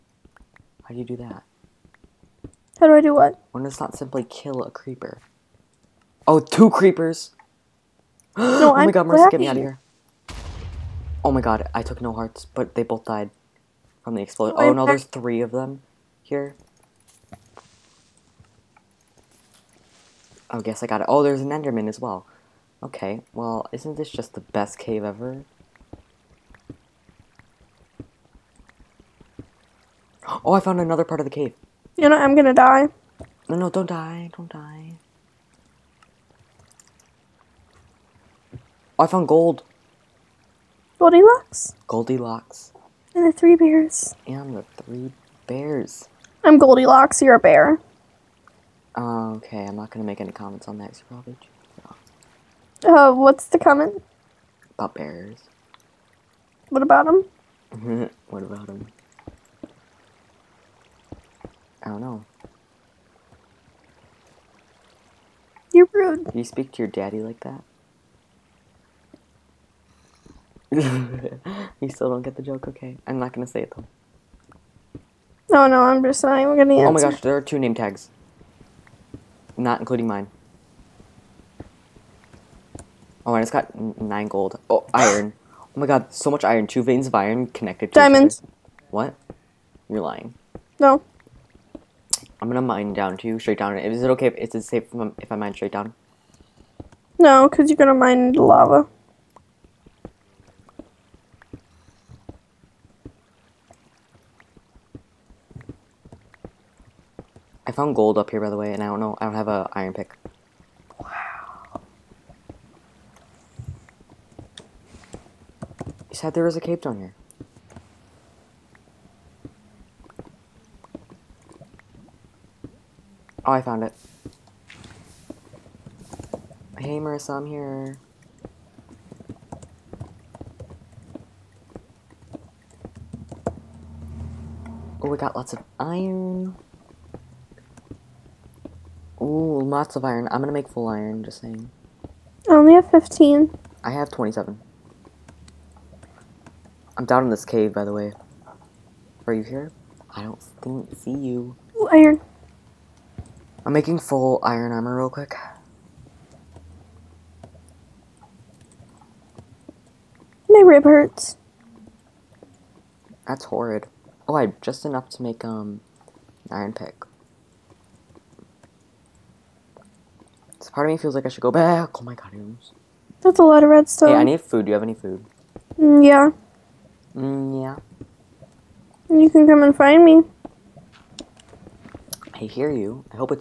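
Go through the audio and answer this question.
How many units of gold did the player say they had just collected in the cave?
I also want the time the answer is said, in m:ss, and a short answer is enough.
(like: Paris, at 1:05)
9, at 1:24.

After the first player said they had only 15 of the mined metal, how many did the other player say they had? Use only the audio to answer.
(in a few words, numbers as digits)
27.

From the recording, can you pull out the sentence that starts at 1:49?
I don't have a iron pick.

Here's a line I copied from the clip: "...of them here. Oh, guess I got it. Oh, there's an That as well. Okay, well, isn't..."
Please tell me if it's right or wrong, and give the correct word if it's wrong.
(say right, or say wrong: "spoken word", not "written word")
wrong: "Enderman", not "That".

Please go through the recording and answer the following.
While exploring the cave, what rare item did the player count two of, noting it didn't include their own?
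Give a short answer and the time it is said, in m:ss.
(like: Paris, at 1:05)
Name tags, at 1:17.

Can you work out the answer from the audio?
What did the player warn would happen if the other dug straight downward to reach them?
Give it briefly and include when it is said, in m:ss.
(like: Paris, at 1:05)
Mine into lava, at 1:37.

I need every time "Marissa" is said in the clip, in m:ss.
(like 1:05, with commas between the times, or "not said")
0:09, 2:06.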